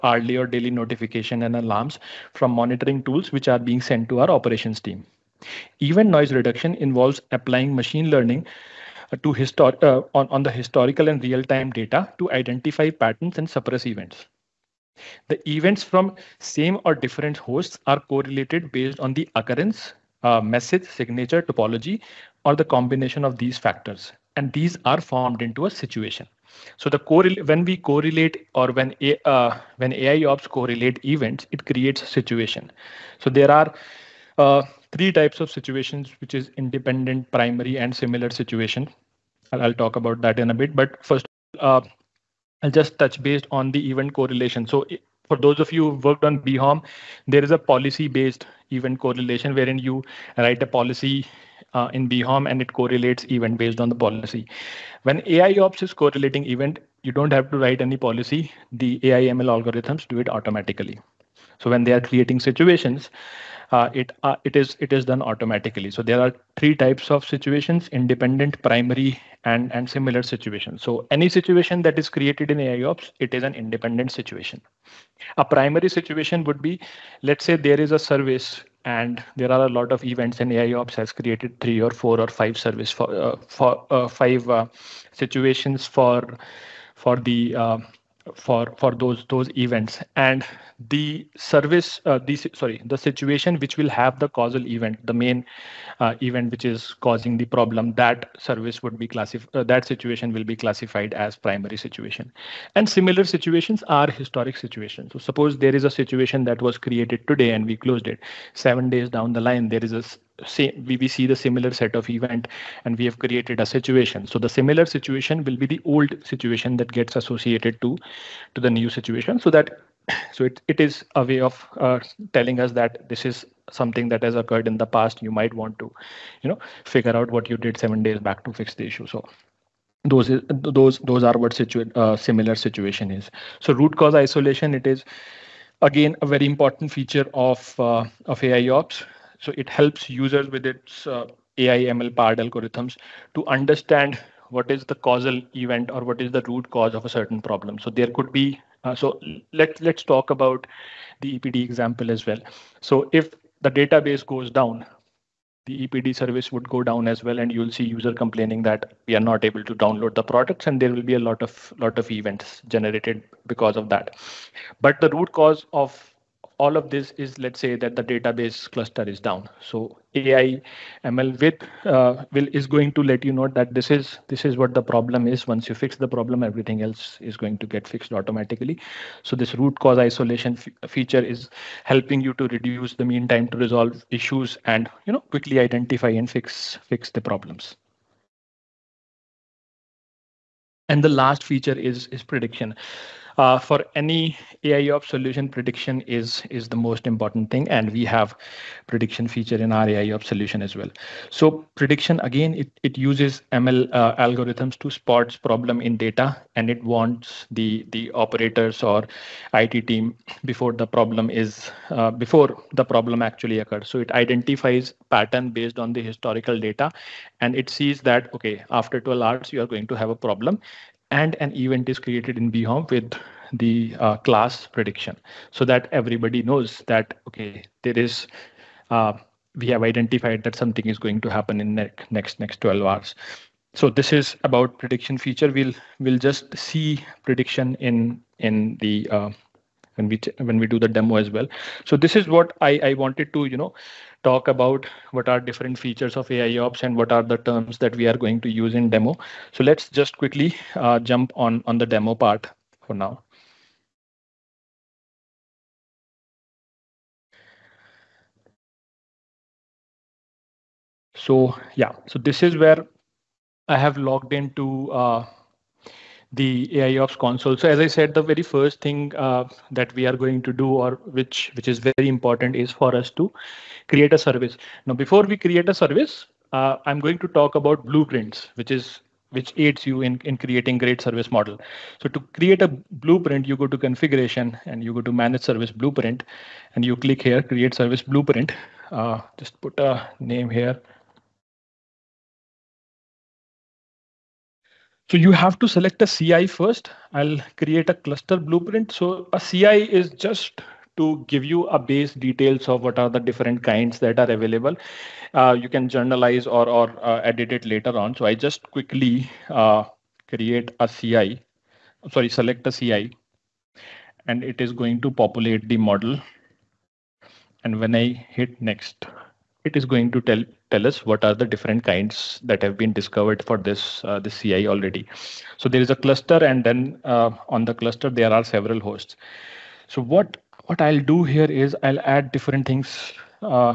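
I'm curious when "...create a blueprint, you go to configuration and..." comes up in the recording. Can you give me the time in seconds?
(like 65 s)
282 s.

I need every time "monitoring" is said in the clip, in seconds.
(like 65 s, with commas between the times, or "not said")
2 s.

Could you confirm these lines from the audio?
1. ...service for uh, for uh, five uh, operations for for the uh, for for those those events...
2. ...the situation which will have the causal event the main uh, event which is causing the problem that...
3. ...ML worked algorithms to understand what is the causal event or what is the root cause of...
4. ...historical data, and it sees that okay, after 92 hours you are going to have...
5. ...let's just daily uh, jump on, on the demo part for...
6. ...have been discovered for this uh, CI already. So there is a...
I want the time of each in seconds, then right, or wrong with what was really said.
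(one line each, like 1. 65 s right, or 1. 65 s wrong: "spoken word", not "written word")
1. 82 s wrong: "situations", not "operations"
2. 92 s right
3. 141 s wrong: "powered", not "worked"
4. 216 s wrong: "12", not "92"
5. 249 s wrong: "quickly", not "daily"
6. 322 s right.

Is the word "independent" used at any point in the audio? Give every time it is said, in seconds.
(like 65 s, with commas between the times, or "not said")
36 s, 67 s, 73 s.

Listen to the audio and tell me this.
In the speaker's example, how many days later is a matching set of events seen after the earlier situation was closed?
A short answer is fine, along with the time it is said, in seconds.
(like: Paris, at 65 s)
7, at 108 s.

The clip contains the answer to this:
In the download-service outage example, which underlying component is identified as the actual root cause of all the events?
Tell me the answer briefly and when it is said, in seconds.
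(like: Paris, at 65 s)
database cluster, at 168 s.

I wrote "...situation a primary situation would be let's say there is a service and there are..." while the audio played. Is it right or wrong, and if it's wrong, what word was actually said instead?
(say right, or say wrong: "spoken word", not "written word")
right.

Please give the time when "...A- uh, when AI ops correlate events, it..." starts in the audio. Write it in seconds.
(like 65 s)
29 s.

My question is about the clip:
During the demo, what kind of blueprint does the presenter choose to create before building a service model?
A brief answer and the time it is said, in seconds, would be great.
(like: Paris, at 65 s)
cluster blueprint, at 297 s.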